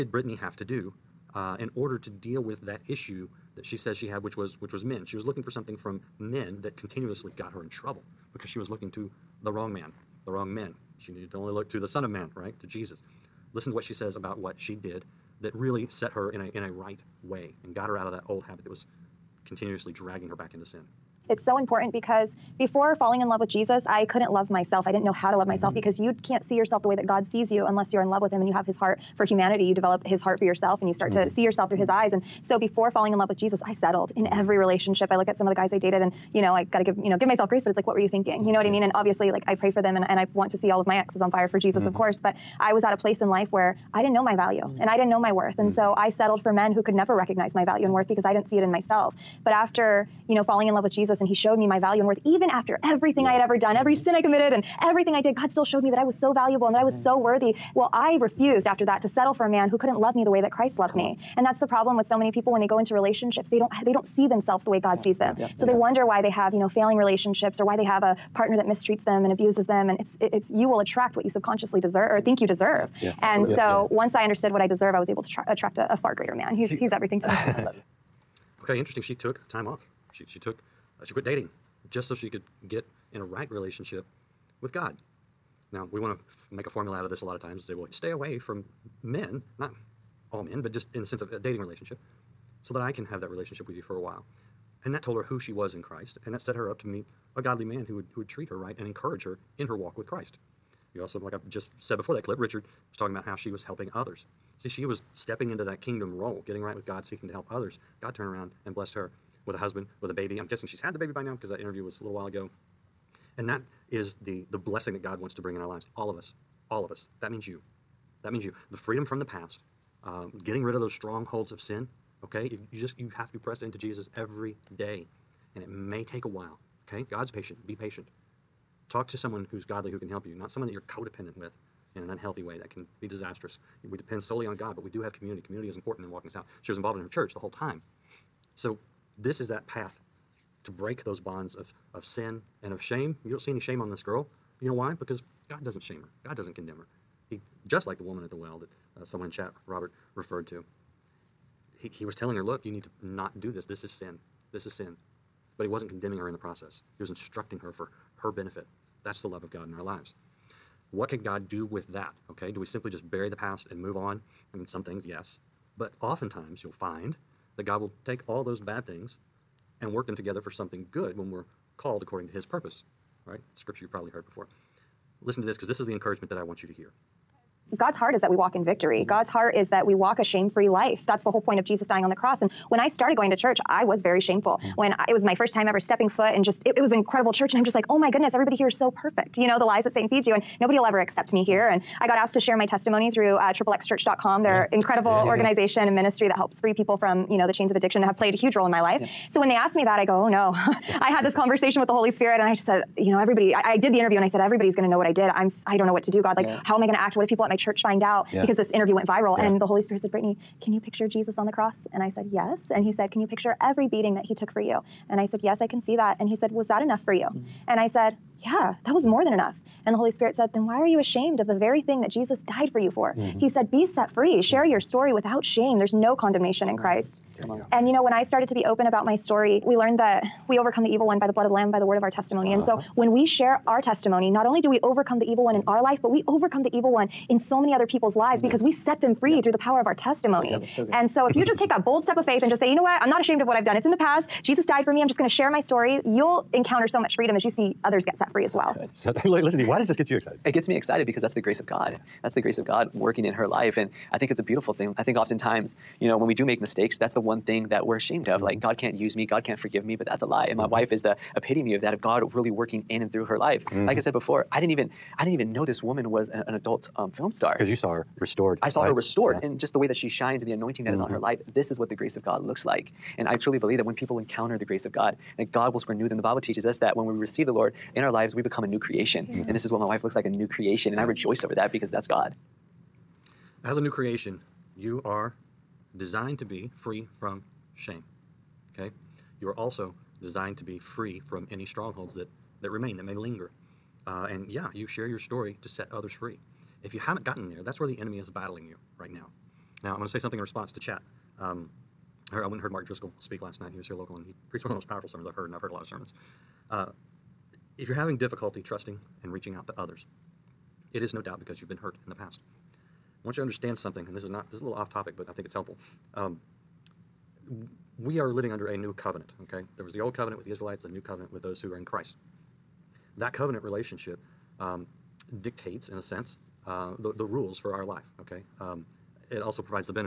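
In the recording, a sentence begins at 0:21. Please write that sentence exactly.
It's so important because before falling in love with Jesus, I couldn't love myself.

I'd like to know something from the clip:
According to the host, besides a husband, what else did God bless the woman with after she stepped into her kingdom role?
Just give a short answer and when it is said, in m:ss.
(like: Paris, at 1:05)
a baby, at 1:50.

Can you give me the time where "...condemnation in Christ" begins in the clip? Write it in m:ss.
3:46.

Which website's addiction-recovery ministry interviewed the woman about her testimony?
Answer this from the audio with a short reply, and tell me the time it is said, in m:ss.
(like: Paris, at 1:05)
XXXchurch.com, at 3:13.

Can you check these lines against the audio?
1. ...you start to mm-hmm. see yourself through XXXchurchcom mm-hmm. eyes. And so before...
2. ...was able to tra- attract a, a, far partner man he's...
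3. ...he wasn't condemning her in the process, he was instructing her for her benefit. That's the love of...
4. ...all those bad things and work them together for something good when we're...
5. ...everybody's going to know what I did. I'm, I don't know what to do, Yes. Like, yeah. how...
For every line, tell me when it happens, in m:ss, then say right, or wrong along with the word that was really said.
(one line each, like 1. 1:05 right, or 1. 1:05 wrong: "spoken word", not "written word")
1. 0:30 wrong: "His", not "XXXchurchcom"
2. 1:14 wrong: "greater", not "partner"
3. 2:35 right
4. 2:48 right
5. 3:24 wrong: "God", not "Yes".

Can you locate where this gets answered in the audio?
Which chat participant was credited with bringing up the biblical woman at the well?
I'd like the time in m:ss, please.
2:29.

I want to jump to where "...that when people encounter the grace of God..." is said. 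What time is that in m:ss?
4:33.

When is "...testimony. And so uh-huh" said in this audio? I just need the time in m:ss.
3:52.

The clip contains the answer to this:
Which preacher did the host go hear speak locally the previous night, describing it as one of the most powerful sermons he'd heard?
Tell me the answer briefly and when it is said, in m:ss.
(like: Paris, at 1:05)
Mark Driscoll, at 5:02.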